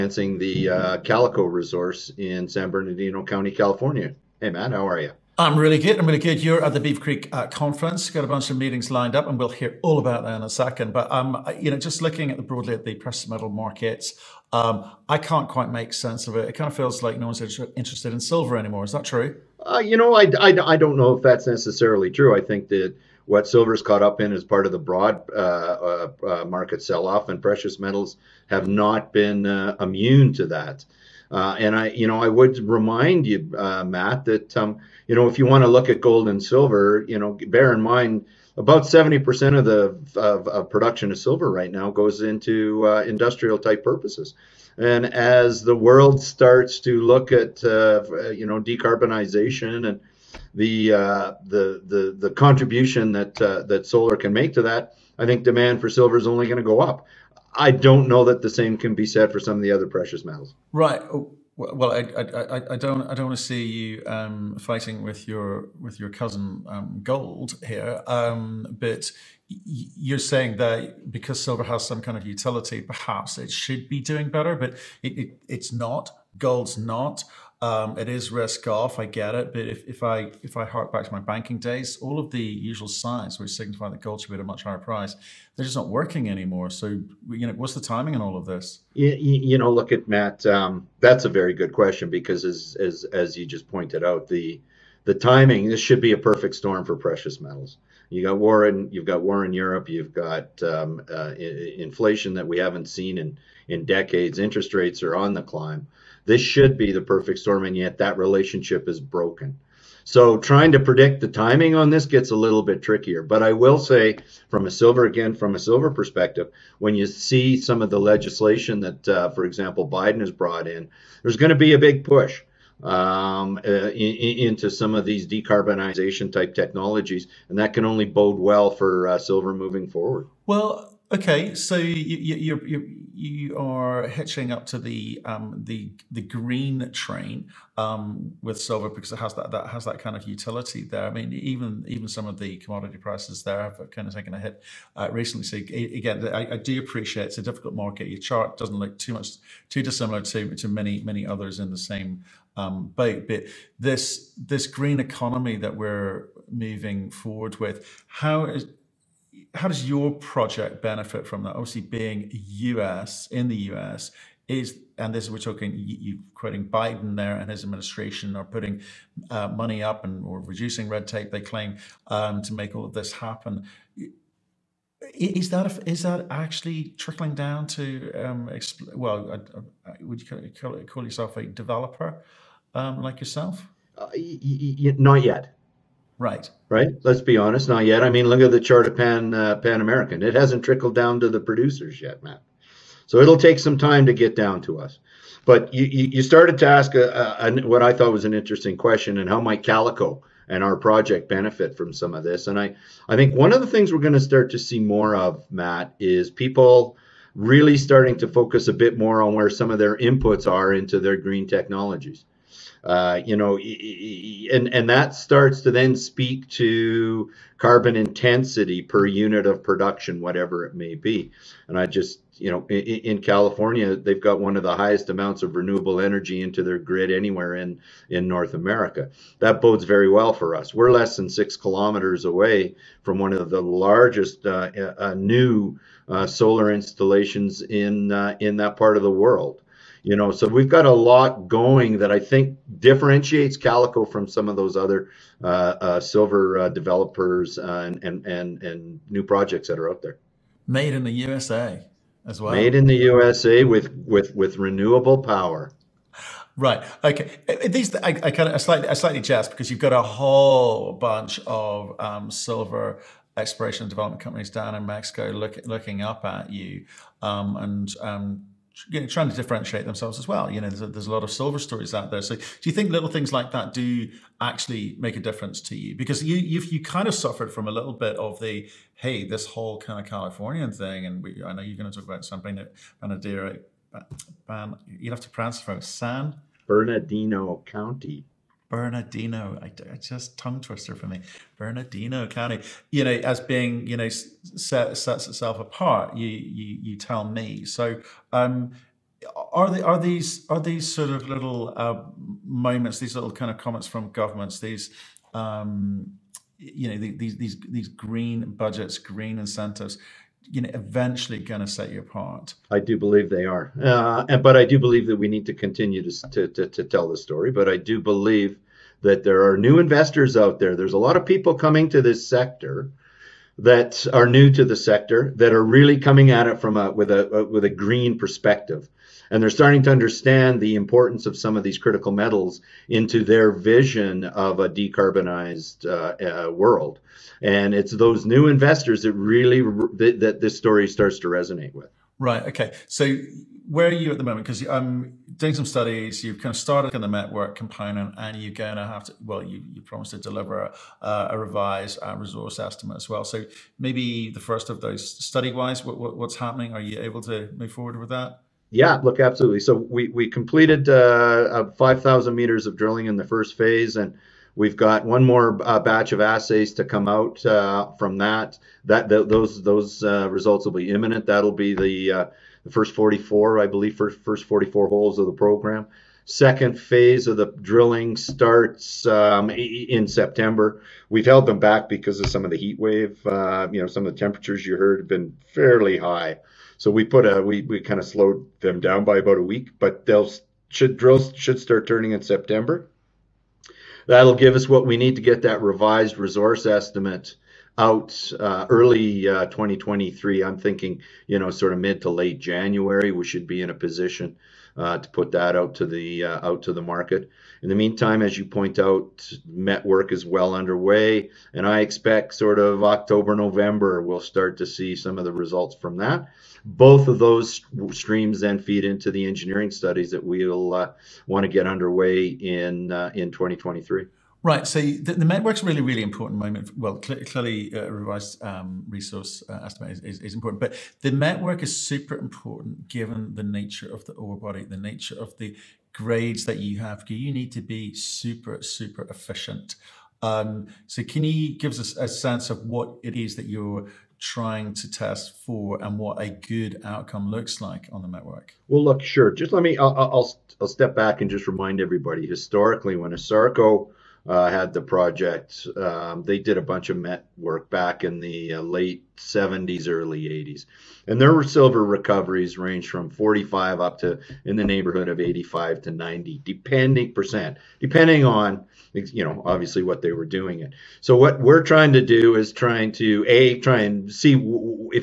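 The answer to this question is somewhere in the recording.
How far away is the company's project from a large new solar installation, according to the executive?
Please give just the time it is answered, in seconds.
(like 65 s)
230 s.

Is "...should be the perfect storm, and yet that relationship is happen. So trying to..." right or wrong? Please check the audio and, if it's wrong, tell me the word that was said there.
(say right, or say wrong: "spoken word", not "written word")
wrong: "broken", not "happen".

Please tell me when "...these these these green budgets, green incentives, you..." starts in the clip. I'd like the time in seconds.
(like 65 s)
306 s.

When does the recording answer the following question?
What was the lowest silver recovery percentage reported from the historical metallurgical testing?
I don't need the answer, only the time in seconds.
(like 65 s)
463 s.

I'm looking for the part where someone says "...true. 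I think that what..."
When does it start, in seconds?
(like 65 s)
22 s.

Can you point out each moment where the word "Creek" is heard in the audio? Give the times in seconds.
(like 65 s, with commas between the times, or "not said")
6 s.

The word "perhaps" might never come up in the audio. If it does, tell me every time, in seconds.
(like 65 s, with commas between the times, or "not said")
72 s.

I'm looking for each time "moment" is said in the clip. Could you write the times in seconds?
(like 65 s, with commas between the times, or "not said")
302 s, 344 s, 426 s.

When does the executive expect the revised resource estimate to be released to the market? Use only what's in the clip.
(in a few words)
early 2023.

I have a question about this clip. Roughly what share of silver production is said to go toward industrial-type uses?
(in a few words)
70%.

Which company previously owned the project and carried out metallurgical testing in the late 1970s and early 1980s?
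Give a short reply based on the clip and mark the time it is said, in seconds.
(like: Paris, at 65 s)
Asarco, at 453 s.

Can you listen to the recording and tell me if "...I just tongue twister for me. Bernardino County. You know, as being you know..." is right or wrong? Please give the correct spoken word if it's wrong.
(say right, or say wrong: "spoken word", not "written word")
right.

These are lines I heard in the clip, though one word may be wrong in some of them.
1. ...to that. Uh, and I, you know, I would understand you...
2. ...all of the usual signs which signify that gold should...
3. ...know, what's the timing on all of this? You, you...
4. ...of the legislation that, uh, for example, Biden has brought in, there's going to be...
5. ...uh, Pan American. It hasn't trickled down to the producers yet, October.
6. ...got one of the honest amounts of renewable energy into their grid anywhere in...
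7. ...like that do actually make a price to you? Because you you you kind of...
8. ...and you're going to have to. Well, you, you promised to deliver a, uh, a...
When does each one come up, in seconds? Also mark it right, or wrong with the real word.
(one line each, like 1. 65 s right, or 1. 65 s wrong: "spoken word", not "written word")
1. 30 s wrong: "remind", not "understand"
2. 81 s right
3. 87 s right
4. 117 s right
5. 189 s wrong: "Matt", not "October"
6. 224 s wrong: "highest", not "honest"
7. 273 s wrong: "difference", not "price"
8. 348 s right.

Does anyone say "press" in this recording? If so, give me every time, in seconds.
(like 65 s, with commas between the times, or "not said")
not said.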